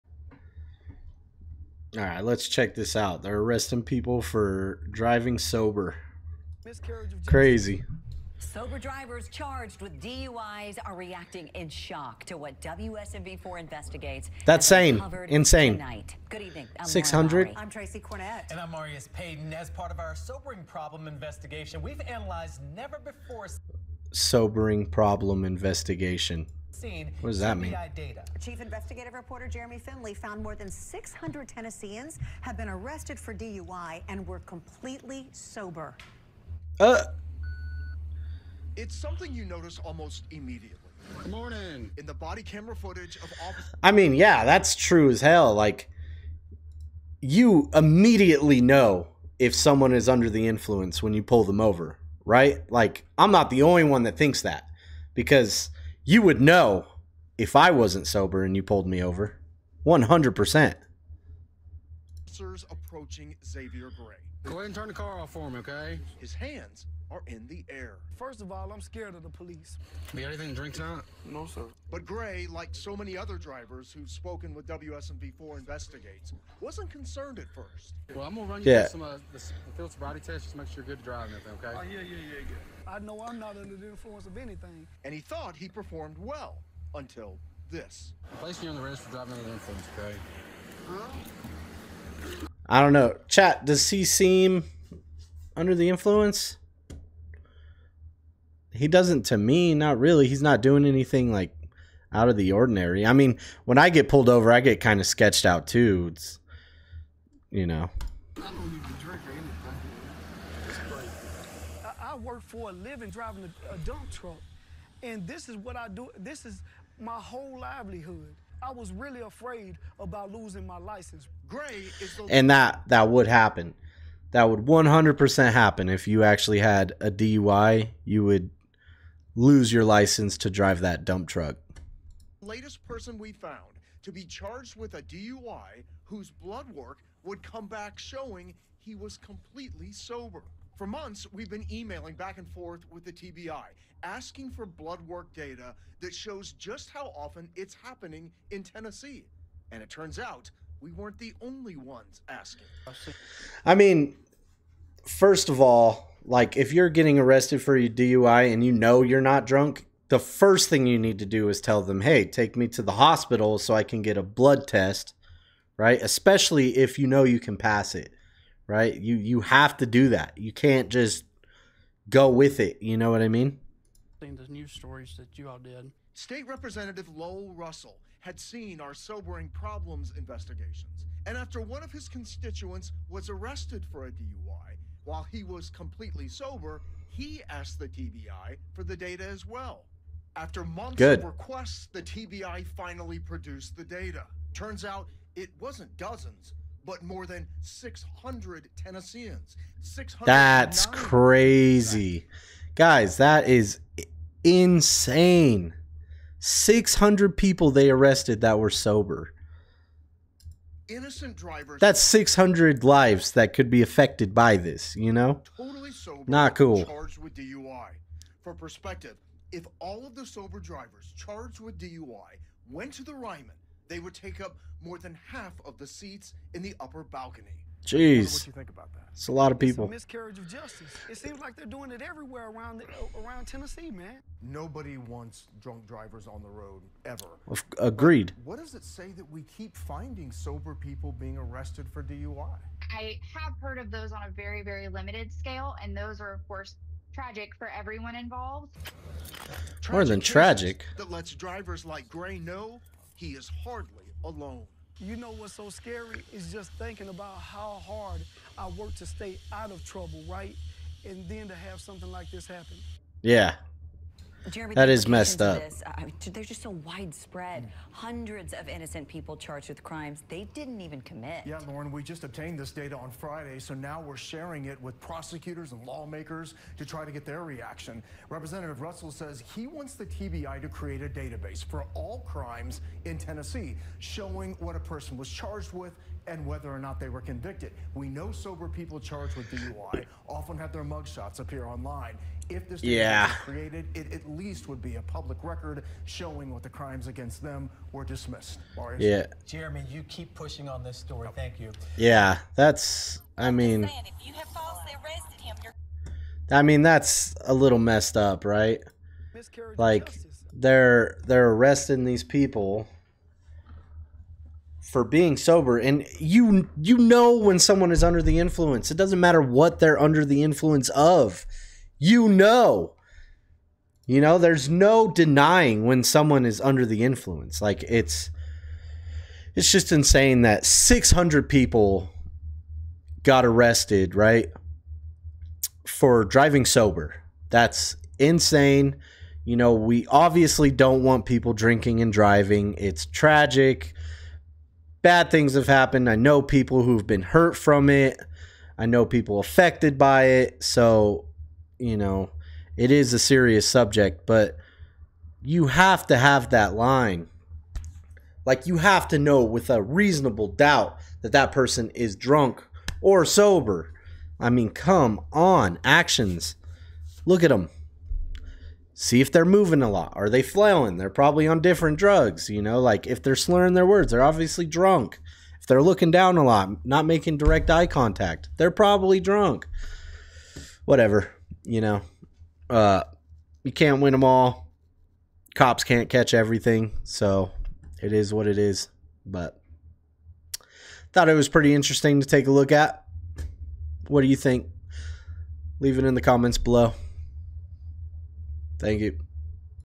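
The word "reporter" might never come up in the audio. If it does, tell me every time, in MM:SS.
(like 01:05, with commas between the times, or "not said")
00:29.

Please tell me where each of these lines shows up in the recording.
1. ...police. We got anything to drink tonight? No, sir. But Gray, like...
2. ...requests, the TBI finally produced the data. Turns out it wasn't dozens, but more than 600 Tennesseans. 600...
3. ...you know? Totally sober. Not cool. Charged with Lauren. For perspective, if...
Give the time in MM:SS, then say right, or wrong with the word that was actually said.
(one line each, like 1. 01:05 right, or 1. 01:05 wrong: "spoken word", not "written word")
1. 01:09 right
2. 03:11 right
3. 03:34 wrong: "DUI", not "Lauren".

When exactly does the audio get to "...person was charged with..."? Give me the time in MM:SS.
04:44.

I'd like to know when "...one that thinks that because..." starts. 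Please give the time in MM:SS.
00:53.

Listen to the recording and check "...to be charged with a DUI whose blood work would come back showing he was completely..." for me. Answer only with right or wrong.
right.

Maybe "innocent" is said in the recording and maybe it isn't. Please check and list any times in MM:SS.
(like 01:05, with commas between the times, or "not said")
03:30, 04:28.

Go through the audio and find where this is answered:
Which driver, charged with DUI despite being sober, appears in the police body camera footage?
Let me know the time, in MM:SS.
01:03.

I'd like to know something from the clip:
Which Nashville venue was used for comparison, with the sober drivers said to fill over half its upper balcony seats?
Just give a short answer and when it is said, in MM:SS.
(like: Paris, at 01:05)
The Ryman, at 03:43.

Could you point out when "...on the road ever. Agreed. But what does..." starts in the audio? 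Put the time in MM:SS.
03:56.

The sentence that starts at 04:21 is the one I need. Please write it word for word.
And then to have something like this happen.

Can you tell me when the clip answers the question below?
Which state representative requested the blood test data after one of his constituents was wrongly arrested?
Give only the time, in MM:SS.
02:57.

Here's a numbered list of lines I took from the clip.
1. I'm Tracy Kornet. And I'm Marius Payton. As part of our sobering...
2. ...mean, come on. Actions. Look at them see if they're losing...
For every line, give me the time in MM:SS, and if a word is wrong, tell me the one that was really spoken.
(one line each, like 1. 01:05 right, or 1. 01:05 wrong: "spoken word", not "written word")
1. 00:17 right
2. 06:04 wrong: "moving", not "losing".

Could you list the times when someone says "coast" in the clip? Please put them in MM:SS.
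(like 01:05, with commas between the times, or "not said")
not said.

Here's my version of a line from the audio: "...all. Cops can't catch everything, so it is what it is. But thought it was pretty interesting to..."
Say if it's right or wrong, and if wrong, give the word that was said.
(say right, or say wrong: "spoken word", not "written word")
right.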